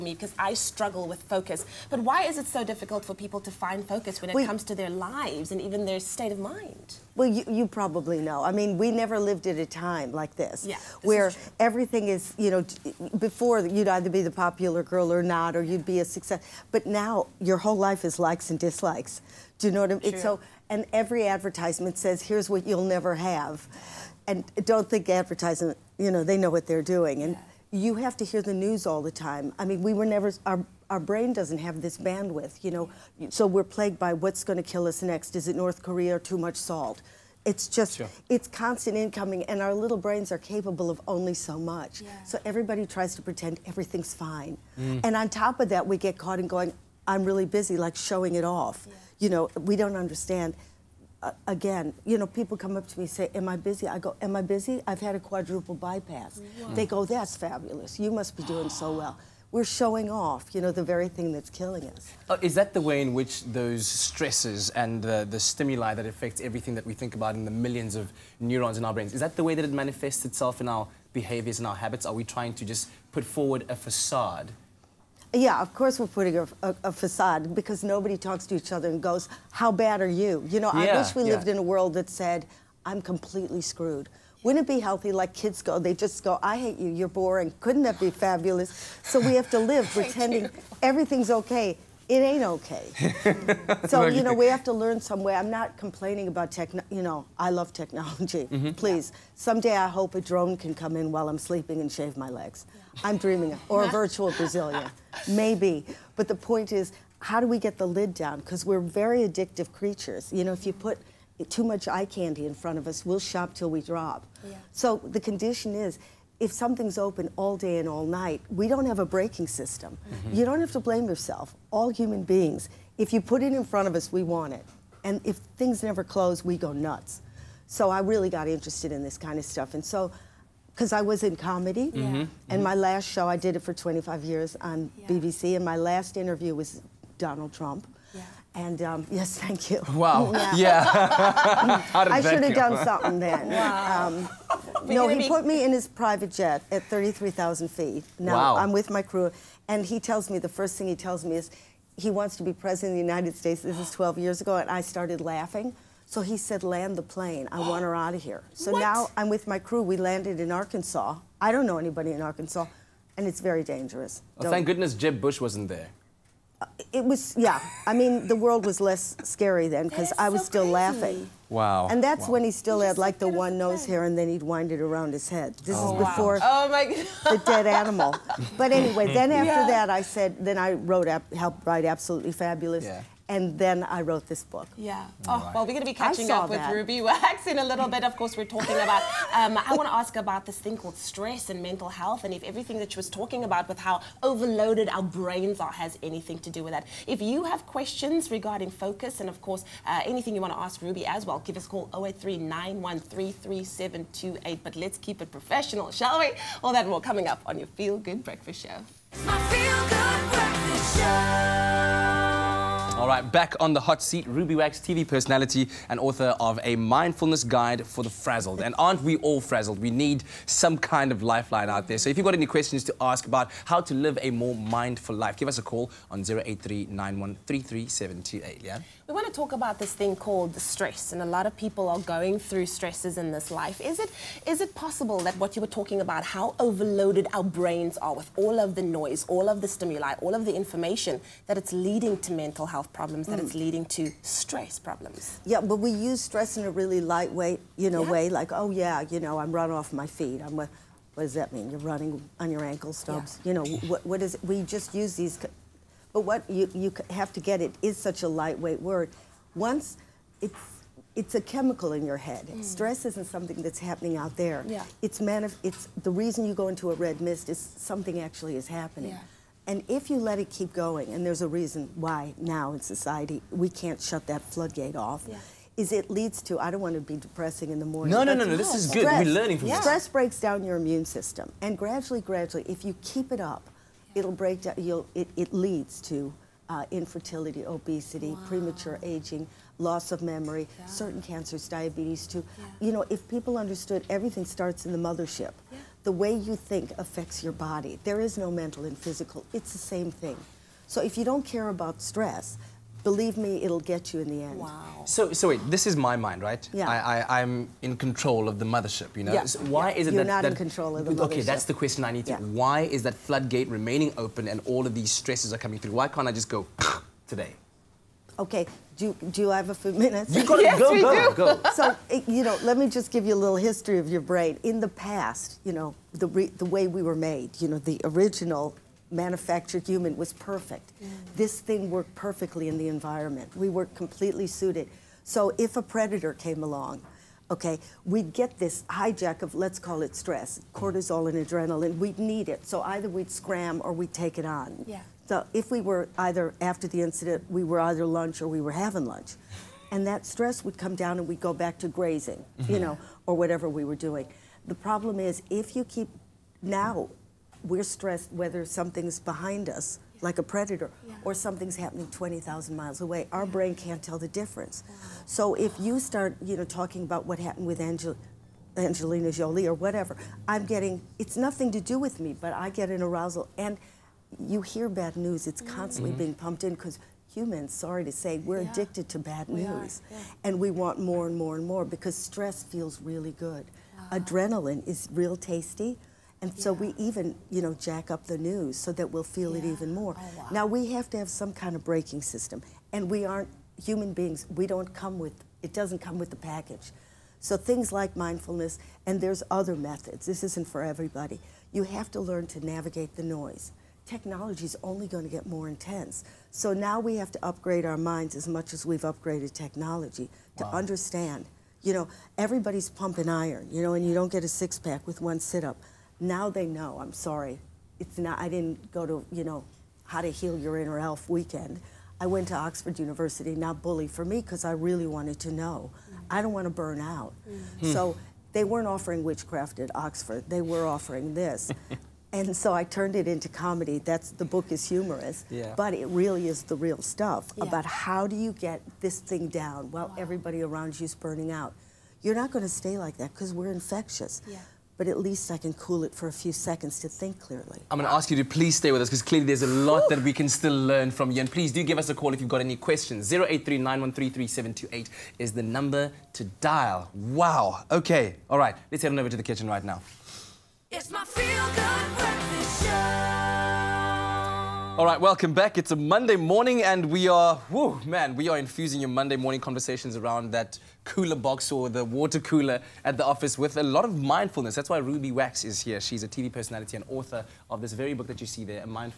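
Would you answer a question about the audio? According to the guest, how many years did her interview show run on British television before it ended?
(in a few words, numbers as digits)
25.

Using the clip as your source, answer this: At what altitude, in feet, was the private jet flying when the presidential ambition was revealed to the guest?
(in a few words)
33,000.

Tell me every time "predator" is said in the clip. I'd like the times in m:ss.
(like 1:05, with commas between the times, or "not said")
5:35, 6:00.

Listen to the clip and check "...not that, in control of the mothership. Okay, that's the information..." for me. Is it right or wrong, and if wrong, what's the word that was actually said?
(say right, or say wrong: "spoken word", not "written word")
wrong: "question", not "information".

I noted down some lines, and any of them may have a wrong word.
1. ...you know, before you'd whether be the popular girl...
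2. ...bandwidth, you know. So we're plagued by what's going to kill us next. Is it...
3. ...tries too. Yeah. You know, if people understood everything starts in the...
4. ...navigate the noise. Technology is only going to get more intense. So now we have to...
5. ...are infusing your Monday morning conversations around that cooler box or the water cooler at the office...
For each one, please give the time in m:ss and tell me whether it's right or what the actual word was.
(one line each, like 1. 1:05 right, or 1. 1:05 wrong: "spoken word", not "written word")
1. 0:12 wrong: "either", not "whether"
2. 0:31 right
3. 4:51 wrong: "diabetes", not "tries"
4. 6:42 right
5. 7:48 right.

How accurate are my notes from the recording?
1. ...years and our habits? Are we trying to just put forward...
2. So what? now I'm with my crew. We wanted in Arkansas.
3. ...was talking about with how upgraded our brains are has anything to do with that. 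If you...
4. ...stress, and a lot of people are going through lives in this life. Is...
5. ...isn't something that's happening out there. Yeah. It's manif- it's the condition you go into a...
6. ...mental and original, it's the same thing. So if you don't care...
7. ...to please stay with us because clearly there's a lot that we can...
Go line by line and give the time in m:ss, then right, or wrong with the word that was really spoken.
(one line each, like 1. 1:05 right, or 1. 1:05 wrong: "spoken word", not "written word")
1. 1:11 wrong: "behaviors", not "years"
2. 2:38 wrong: "landed", not "wanted"
3. 3:12 wrong: "overloaded", not "upgraded"
4. 3:50 wrong: "stresses", not "lives"
5. 4:23 wrong: "reason", not "condition"
6. 4:58 wrong: "physical", not "original"
7. 7:28 right.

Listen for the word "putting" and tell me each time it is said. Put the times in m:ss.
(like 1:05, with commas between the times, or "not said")
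1:16.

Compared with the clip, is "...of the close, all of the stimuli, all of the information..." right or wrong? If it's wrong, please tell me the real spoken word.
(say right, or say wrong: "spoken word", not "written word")
wrong: "noise", not "close".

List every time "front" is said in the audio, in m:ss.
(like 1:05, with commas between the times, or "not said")
1:52, 2:03.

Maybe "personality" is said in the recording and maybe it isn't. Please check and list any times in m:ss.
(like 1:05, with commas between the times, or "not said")
3:35, 7:56.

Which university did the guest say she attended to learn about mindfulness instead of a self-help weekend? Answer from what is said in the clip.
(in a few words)
Oxford University.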